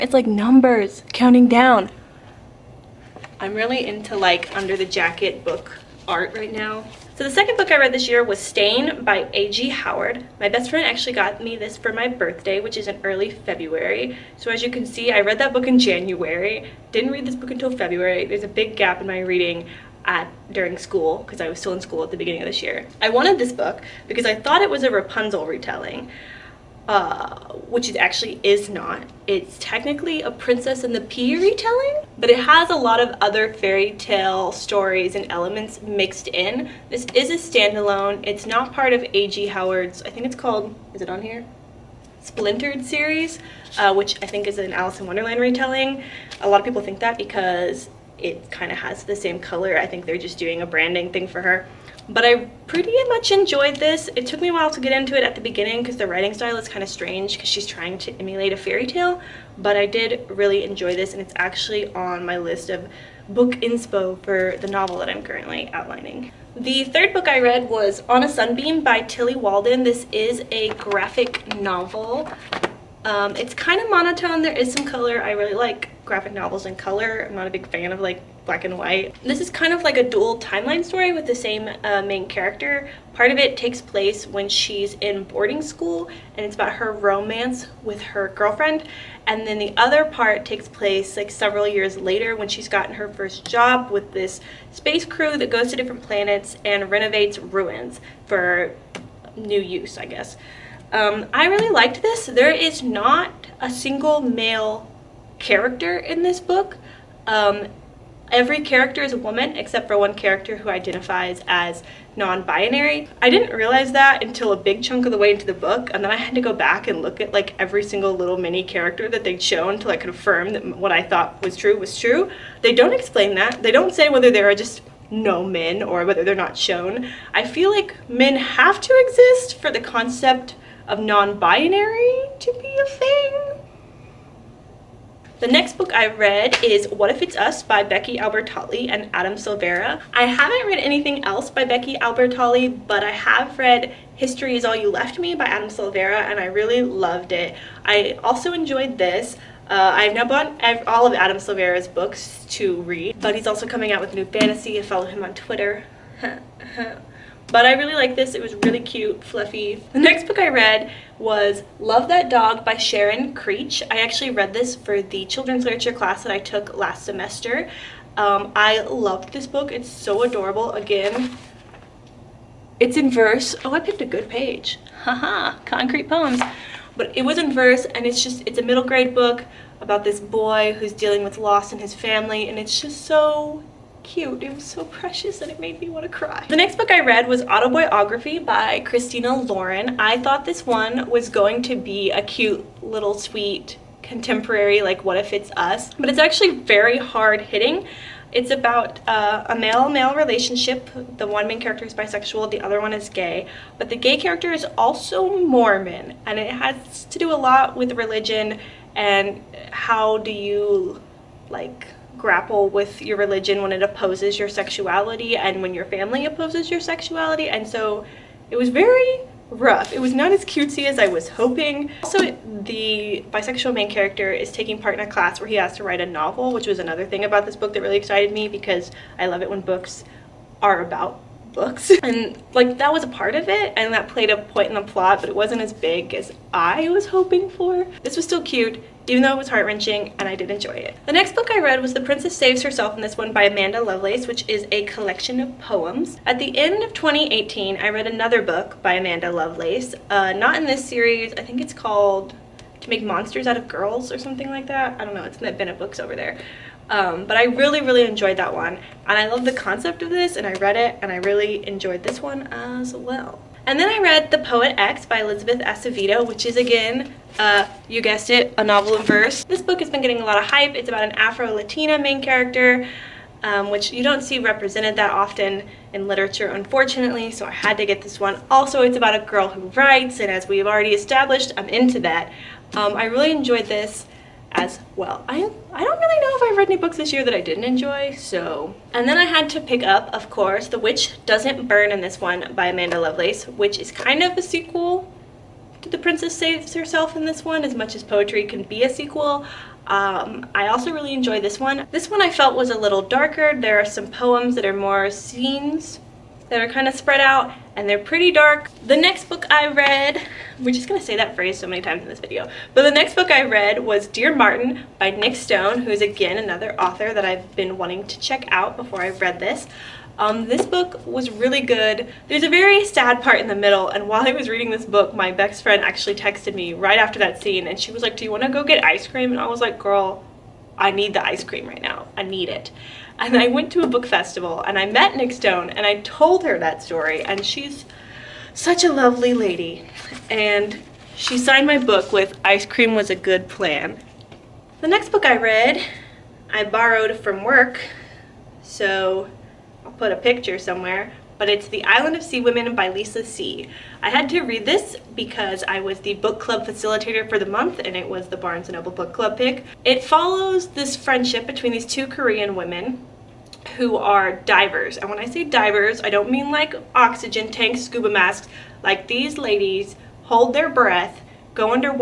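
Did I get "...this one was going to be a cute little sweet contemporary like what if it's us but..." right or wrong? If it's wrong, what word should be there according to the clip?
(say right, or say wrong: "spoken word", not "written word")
right.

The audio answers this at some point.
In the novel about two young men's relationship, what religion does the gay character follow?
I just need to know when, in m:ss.
3:25.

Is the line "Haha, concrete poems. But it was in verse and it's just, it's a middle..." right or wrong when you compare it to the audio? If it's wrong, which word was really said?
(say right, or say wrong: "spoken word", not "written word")
right.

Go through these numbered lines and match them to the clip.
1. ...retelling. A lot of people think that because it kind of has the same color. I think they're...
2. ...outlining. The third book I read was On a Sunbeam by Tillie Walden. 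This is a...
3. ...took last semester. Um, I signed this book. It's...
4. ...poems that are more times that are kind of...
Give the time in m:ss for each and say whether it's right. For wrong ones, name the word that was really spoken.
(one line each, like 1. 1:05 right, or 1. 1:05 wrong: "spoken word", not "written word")
1. 0:45 right
2. 1:05 right
3. 2:46 wrong: "loved", not "signed"
4. 5:04 wrong: "scenes", not "times".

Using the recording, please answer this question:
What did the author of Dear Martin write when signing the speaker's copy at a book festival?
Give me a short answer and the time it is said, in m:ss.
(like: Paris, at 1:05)
Ice Cream Was a Good Plan, at 5:42.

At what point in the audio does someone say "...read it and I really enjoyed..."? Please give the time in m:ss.
4:20.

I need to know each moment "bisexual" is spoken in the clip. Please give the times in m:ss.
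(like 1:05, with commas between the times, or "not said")
3:21, 3:43.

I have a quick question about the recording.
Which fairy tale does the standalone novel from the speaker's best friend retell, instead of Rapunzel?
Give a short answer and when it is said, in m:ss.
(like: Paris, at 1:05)
Princess and the Pea, at 0:30.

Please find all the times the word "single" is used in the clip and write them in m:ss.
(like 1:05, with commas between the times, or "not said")
1:43, 1:57.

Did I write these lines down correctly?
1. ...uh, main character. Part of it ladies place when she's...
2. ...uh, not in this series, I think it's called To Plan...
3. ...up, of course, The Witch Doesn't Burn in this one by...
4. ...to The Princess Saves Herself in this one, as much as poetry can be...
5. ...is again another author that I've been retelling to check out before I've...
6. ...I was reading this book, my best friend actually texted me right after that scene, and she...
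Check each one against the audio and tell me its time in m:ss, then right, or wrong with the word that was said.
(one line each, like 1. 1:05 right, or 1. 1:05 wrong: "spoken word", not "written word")
1. 1:21 wrong: "takes", not "ladies"
2. 4:10 wrong: "Make", not "Plan"
3. 4:49 right
4. 4:55 right
5. 5:15 wrong: "wanting", not "retelling"
6. 5:24 right.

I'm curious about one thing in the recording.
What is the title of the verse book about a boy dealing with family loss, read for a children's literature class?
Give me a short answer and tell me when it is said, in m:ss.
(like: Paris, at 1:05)
Love That Dog, at 2:41.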